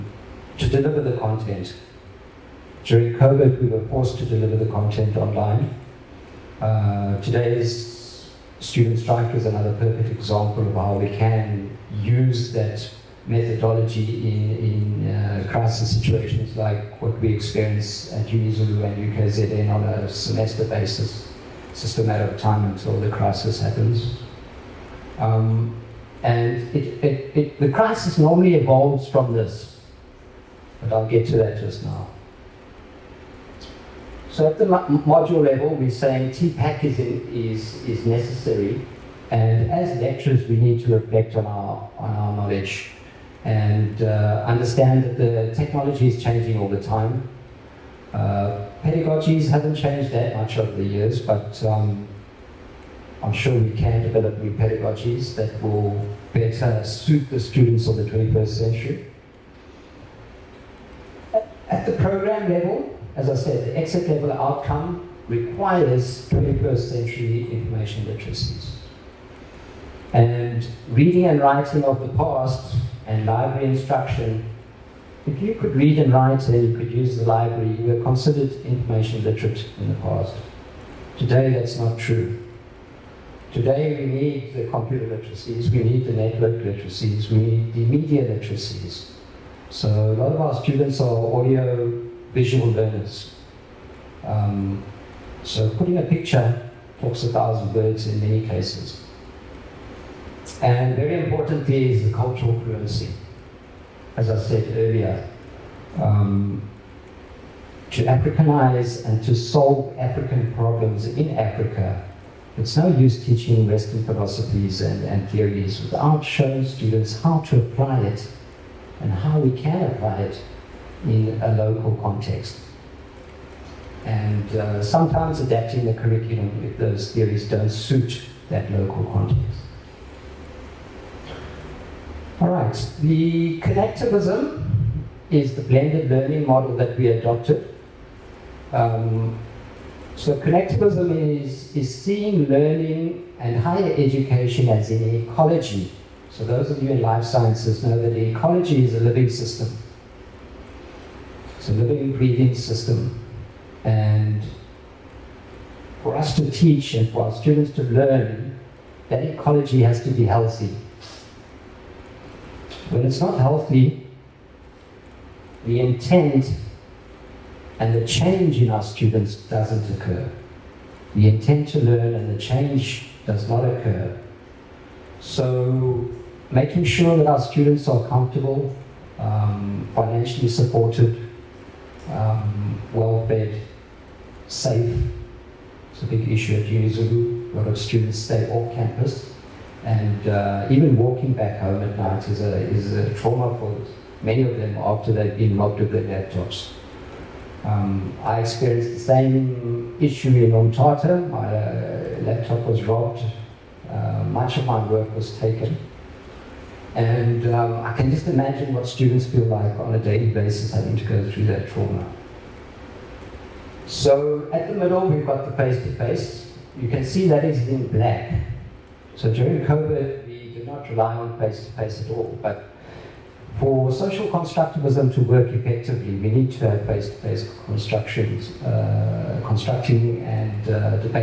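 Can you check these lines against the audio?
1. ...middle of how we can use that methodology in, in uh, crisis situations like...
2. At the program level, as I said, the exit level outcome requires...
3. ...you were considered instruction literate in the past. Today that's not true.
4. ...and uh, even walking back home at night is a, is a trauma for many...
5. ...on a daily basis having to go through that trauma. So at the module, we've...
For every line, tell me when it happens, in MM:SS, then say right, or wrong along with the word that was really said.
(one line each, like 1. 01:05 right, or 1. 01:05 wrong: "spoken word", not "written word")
1. 00:10 wrong: "example", not "middle"
2. 01:01 right
3. 01:17 wrong: "information", not "instruction"
4. 03:09 right
5. 03:29 wrong: "middle", not "module".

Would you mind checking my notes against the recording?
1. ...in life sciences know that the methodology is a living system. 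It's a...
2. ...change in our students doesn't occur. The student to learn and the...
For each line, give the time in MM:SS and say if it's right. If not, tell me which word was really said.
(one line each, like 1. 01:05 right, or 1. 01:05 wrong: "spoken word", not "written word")
1. 02:26 wrong: "ecology", not "methodology"
2. 02:48 wrong: "intent", not "student".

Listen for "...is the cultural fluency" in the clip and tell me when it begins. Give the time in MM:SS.
01:41.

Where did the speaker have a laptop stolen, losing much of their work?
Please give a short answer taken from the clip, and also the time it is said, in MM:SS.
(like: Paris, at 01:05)
Ontata, at 03:20.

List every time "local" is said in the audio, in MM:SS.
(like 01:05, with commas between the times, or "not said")
02:01, 02:08.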